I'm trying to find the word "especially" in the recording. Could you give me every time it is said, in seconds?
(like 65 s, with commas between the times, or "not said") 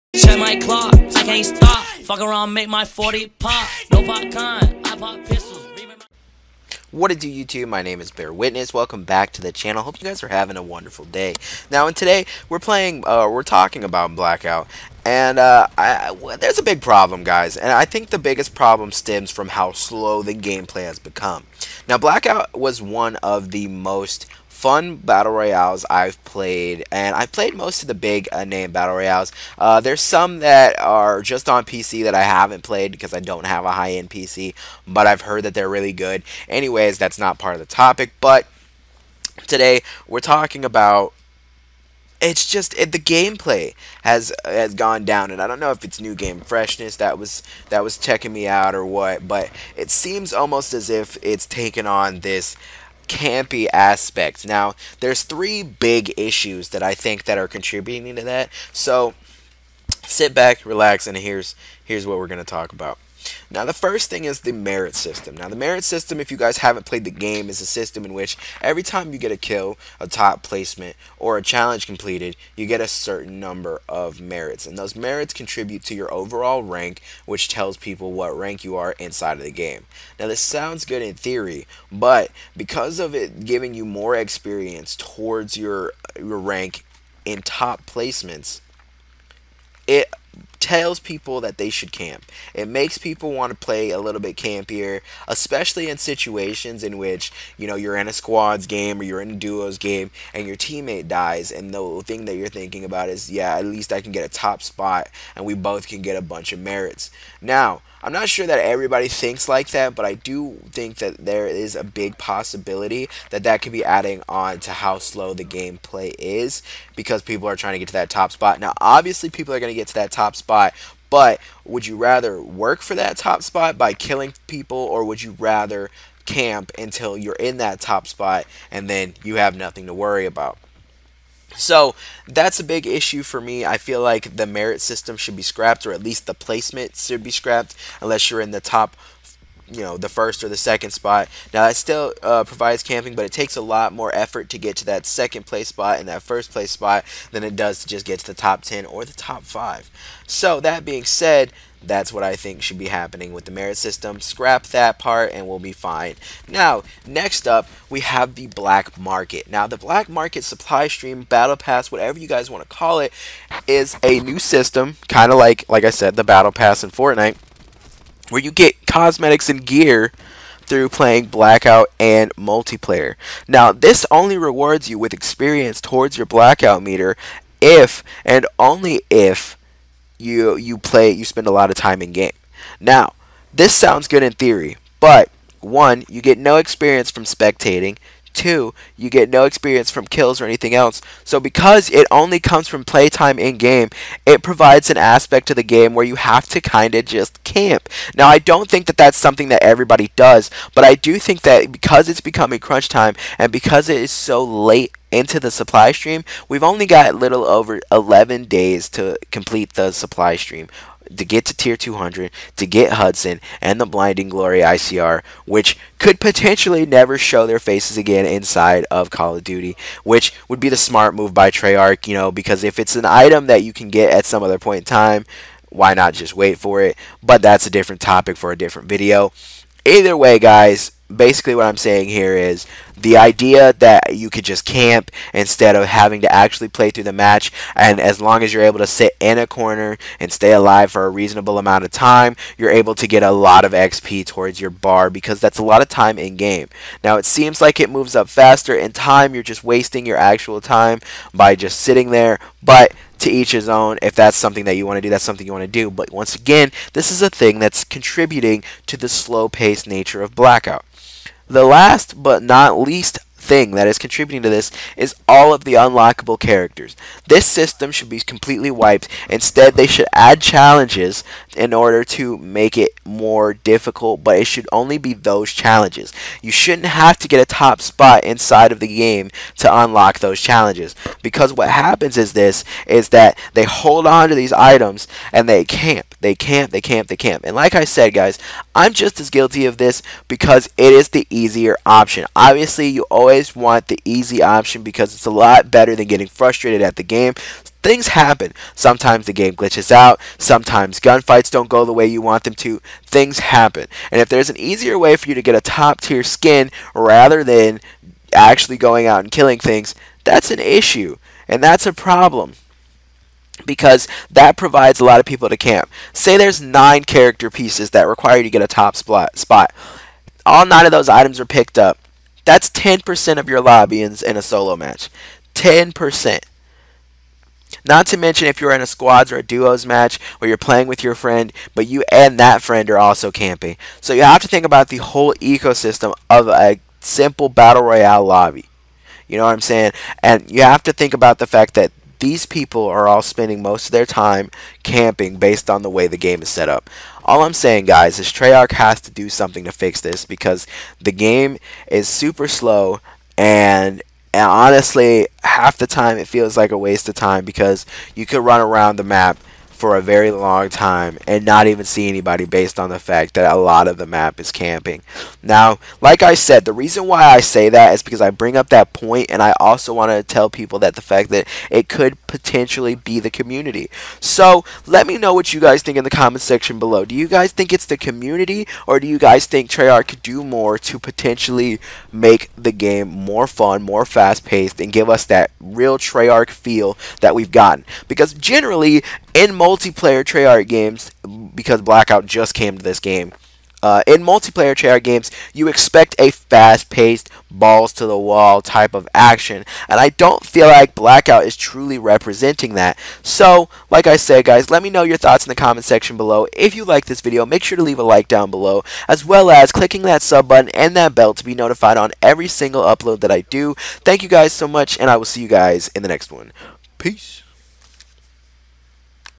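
95 s.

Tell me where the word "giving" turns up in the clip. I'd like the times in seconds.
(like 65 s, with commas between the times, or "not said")
83 s.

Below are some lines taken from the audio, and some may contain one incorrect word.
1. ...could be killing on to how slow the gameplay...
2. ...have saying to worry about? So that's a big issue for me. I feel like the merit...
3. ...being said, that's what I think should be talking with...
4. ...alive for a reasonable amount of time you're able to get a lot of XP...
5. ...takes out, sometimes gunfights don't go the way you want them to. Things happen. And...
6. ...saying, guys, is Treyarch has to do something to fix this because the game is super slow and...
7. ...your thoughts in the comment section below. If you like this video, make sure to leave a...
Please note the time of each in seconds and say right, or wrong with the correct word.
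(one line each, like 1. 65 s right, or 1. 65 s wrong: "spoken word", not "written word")
1. 113 s wrong: "adding", not "killing"
2. 129 s wrong: "nothing", not "saying"
3. 150 s wrong: "happening", not "talking"
4. 240 s right
5. 299 s wrong: "glitches", not "takes"
6. 347 s right
7. 405 s right.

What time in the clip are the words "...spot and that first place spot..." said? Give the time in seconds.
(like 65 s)
145 s.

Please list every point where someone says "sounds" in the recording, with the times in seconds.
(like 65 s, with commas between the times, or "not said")
80 s, 183 s.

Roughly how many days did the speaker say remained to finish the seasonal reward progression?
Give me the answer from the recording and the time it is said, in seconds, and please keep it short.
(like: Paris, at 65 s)
11, at 207 s.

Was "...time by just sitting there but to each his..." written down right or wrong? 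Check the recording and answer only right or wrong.
right.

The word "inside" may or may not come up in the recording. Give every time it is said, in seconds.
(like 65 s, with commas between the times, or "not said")
78 s, 218 s, 278 s.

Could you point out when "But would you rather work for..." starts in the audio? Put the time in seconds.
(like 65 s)
121 s.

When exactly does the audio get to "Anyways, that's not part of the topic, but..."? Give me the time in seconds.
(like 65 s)
36 s.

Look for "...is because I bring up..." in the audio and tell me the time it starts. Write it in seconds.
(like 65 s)
367 s.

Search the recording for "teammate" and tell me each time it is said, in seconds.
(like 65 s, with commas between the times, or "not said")
100 s.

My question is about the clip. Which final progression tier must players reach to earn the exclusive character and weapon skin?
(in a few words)
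200.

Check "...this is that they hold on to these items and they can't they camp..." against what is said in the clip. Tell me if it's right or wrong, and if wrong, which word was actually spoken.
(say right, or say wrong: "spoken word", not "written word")
right.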